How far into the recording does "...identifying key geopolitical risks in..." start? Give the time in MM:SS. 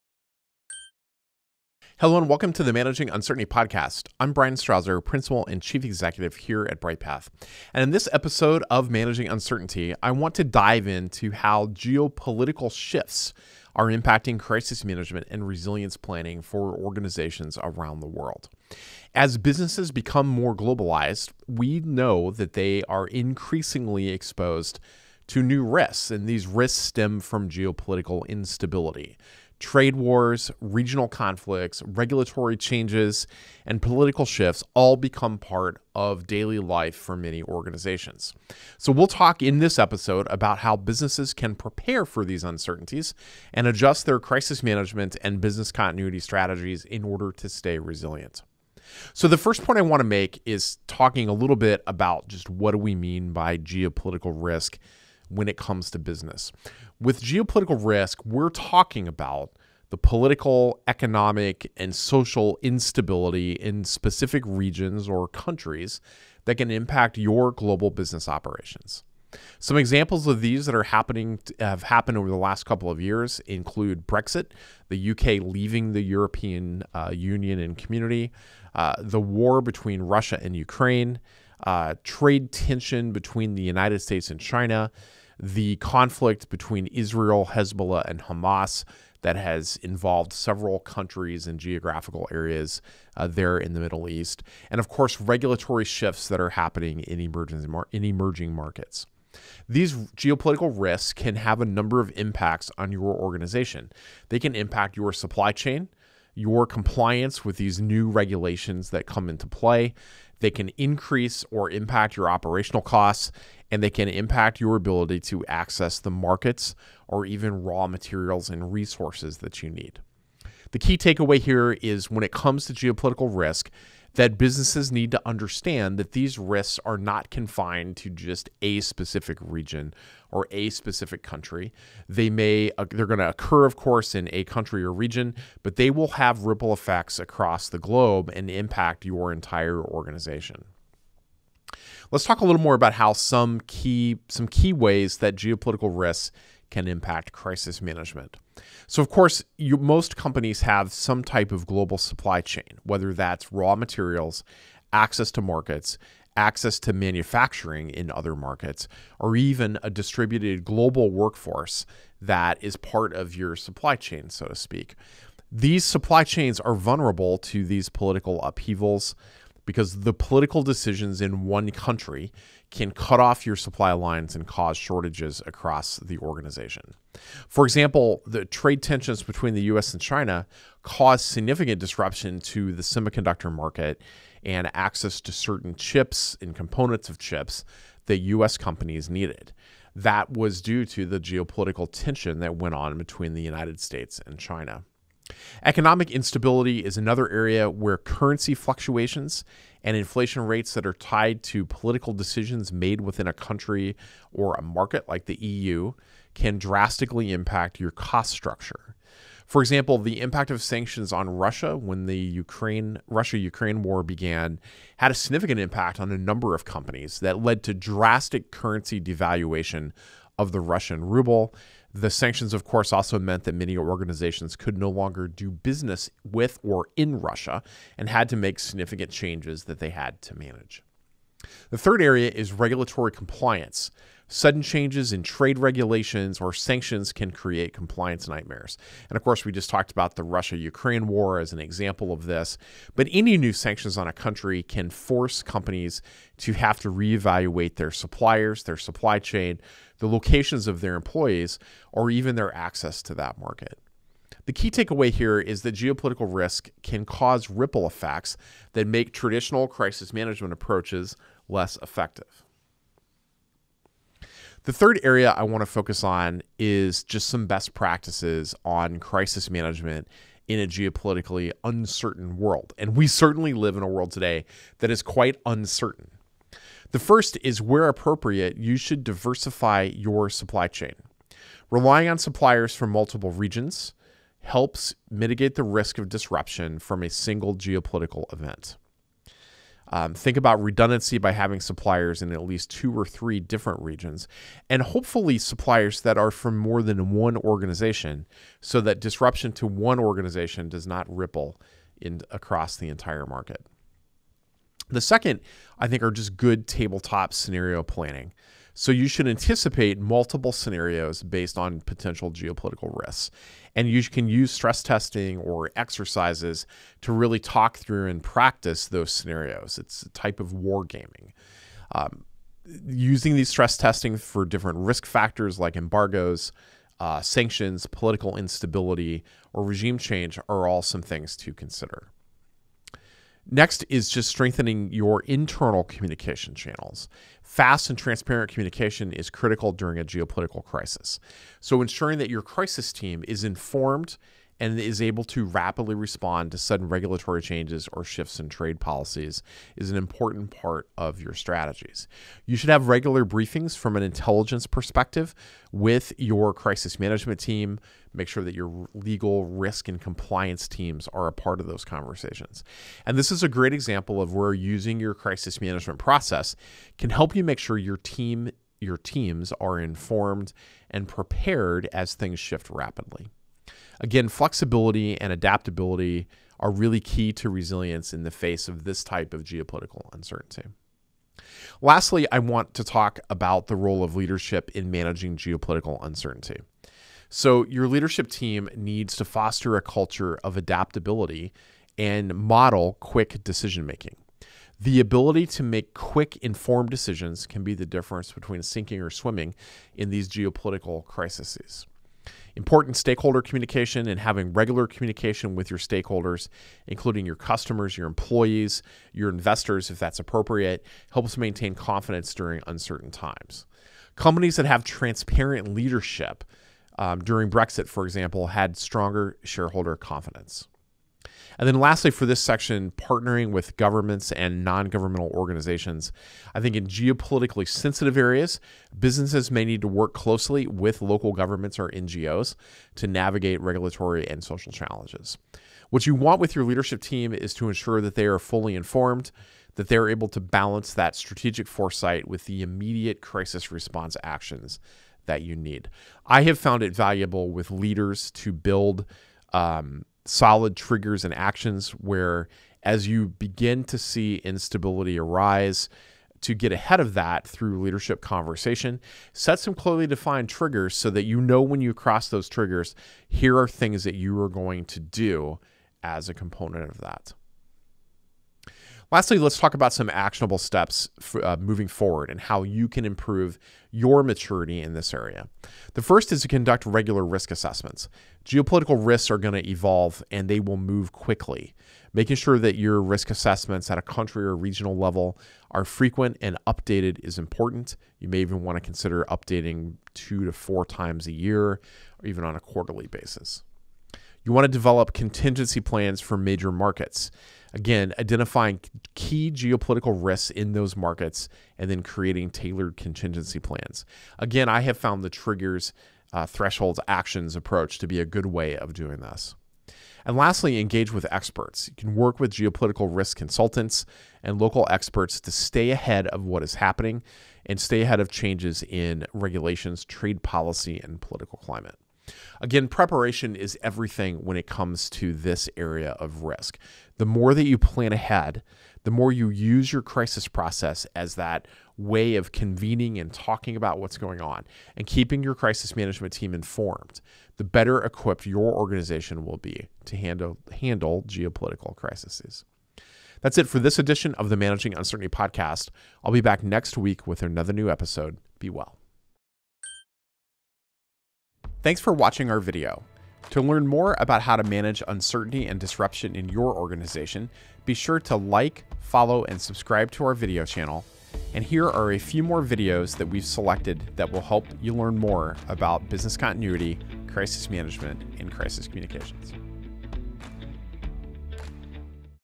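08:18.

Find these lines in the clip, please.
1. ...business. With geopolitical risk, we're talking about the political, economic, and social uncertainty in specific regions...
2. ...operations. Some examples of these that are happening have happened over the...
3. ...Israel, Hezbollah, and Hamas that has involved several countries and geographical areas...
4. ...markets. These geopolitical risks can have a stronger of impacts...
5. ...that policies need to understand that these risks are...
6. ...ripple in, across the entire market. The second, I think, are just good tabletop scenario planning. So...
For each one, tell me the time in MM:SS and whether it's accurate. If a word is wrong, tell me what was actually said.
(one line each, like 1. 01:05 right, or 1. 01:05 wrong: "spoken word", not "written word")
1. 00:55 wrong: "instability", not "uncertainty"
2. 01:08 right
3. 01:26 right
4. 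01:38 wrong: "number", not "stronger"
5. 02:04 wrong: "businesses", not "policies"
6. 05:01 right.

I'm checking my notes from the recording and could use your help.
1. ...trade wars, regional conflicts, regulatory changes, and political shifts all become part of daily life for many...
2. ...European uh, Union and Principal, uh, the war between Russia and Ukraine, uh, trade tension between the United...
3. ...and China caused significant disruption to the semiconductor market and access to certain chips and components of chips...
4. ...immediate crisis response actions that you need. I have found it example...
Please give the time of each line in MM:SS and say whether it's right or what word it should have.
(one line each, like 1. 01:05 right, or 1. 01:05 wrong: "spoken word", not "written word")
1. 00:29 right
2. 01:16 wrong: "Community", not "Principal"
3. 02:59 right
4. 07:22 wrong: "valuable", not "example".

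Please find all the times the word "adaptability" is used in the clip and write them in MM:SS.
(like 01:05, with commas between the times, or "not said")
06:15, 06:30.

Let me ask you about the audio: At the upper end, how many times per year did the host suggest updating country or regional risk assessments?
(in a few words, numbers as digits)
4.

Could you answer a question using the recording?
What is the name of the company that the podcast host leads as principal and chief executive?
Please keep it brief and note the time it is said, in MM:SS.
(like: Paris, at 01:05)
Bryghtpath, at 00:06.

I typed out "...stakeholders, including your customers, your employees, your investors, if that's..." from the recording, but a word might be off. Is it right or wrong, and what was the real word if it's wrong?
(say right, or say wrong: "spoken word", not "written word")
right.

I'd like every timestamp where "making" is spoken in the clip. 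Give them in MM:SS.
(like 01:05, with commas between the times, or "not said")
06:33, 08:02.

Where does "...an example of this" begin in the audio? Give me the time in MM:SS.
04:01.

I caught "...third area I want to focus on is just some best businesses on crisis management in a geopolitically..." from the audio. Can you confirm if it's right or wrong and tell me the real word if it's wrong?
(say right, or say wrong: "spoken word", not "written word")
wrong: "practices", not "businesses".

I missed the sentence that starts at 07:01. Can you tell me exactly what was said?
And then lastly, for this section, partnering with governments and non governmental organizations.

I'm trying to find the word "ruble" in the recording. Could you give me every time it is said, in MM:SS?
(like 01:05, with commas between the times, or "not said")
03:41.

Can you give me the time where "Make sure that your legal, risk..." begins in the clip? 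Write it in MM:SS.
05:58.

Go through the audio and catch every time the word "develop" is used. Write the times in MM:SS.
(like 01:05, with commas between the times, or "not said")
08:14.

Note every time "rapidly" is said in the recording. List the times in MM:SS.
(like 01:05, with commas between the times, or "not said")
05:45, 06:12.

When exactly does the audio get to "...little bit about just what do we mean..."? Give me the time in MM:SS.
00:51.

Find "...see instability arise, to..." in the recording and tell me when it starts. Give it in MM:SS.
07:33.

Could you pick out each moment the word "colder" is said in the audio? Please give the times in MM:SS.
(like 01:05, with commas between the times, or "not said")
not said.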